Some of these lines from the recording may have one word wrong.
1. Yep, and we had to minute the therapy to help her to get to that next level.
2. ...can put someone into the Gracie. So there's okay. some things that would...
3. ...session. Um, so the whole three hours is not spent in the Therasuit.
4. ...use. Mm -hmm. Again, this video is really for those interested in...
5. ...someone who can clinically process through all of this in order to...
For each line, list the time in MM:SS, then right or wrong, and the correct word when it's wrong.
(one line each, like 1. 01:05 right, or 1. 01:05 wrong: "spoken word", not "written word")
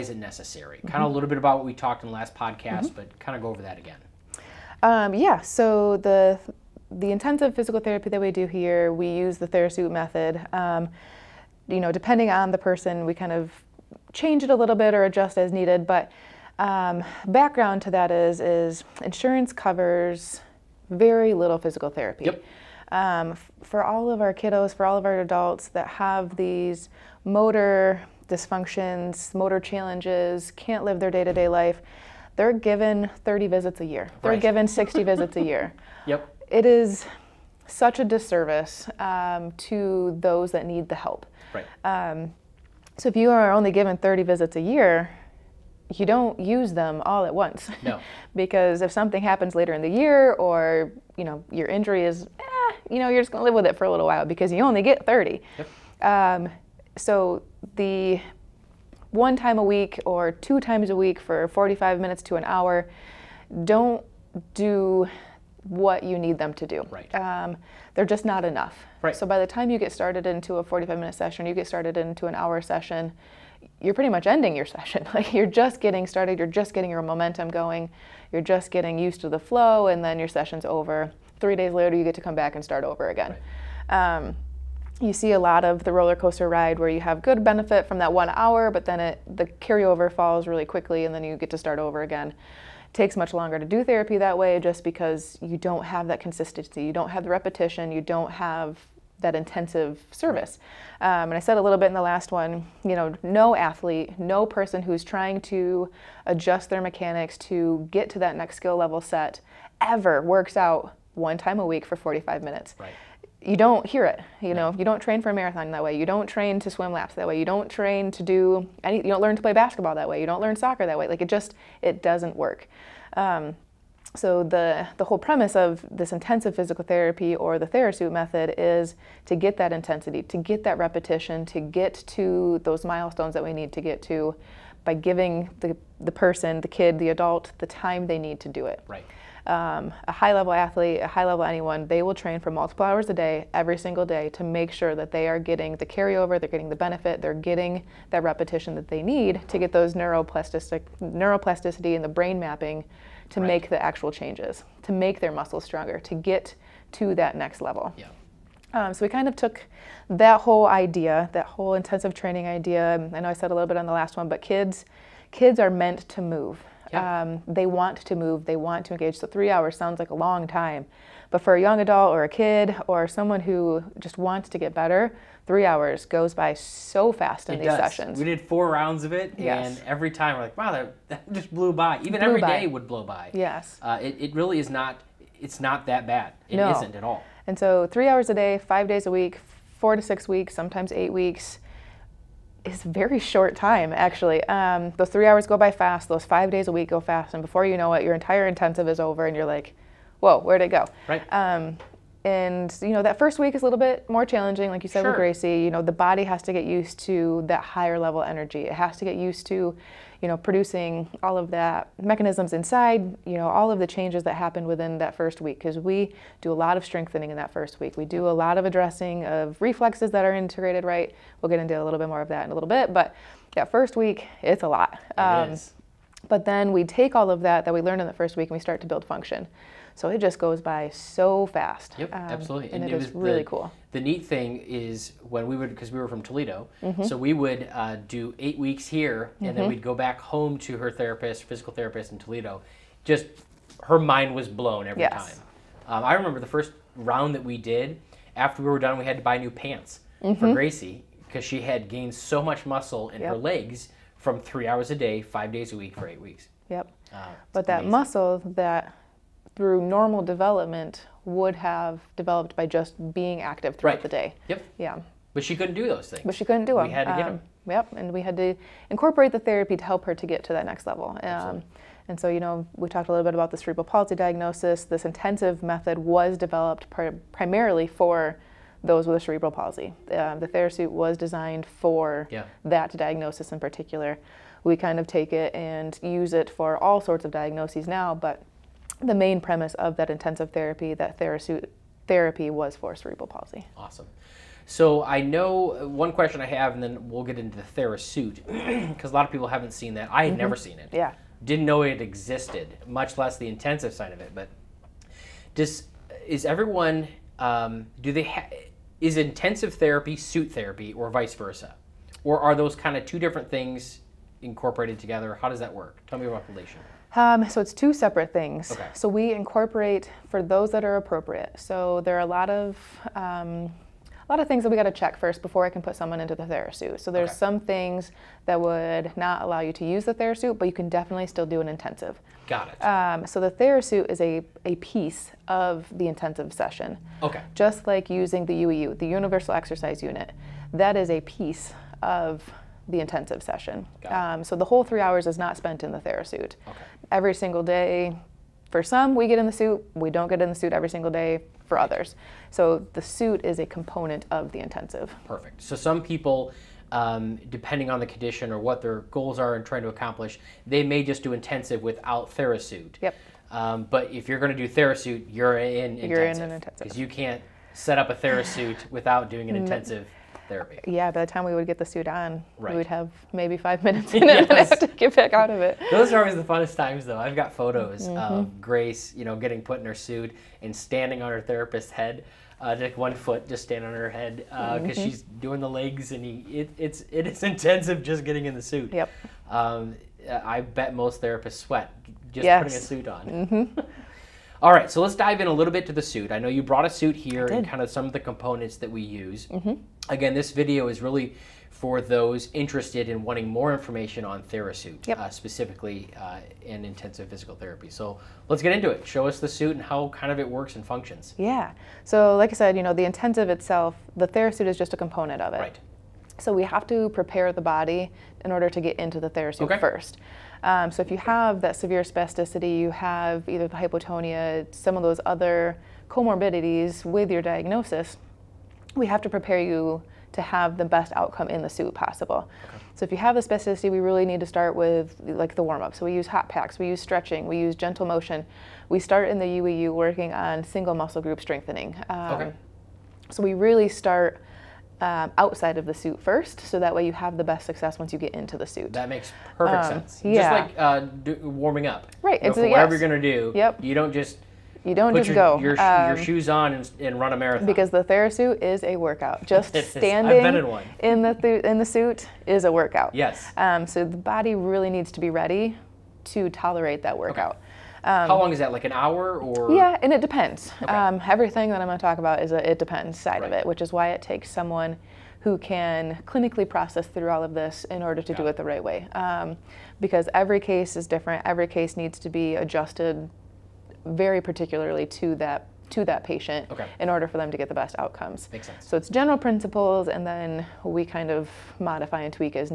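1. 04:27 wrong: "incorporate", not "minute"
2. 05:25 wrong: "Therasuit", not "Gracie"
3. 05:43 right
4. 06:39 right
5. 07:54 right.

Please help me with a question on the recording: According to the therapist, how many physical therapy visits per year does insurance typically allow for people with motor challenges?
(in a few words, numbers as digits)
30.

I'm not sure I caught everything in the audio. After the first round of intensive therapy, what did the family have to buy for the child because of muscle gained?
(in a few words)
new pants.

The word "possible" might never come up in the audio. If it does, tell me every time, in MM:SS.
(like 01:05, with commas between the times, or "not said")
07:11.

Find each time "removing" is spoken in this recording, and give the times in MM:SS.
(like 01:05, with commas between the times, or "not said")
not said.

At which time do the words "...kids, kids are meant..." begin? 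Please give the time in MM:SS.
02:44.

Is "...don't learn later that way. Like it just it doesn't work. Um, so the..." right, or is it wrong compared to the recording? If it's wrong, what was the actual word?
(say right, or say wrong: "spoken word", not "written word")
wrong: "soccer", not "later".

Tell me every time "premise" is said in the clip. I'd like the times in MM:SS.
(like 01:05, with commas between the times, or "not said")
02:05, 04:49.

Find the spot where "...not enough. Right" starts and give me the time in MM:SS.
01:08.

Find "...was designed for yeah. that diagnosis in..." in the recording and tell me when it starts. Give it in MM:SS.
04:40.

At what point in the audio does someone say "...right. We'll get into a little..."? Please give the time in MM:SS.
03:40.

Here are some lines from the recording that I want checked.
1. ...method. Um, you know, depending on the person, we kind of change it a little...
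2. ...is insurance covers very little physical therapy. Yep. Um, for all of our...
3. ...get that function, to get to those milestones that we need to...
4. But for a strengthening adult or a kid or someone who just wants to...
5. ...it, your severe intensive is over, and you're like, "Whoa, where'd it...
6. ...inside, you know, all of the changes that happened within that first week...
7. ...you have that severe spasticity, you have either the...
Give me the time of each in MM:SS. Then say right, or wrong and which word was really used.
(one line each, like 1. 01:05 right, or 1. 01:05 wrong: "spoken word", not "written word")
1. 00:09 right
2. 00:18 right
3. 02:10 wrong: "repetition", not "function"
4. 02:51 wrong: "young", not "strengthening"
5. 03:17 wrong: "entire", not "severe"
6. 03:32 right
7. 07:01 right.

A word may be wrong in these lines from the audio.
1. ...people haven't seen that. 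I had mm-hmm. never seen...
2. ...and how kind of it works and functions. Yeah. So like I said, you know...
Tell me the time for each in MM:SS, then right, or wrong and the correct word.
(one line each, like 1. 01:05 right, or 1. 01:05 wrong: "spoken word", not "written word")
1. 04:59 right
2. 06:49 right.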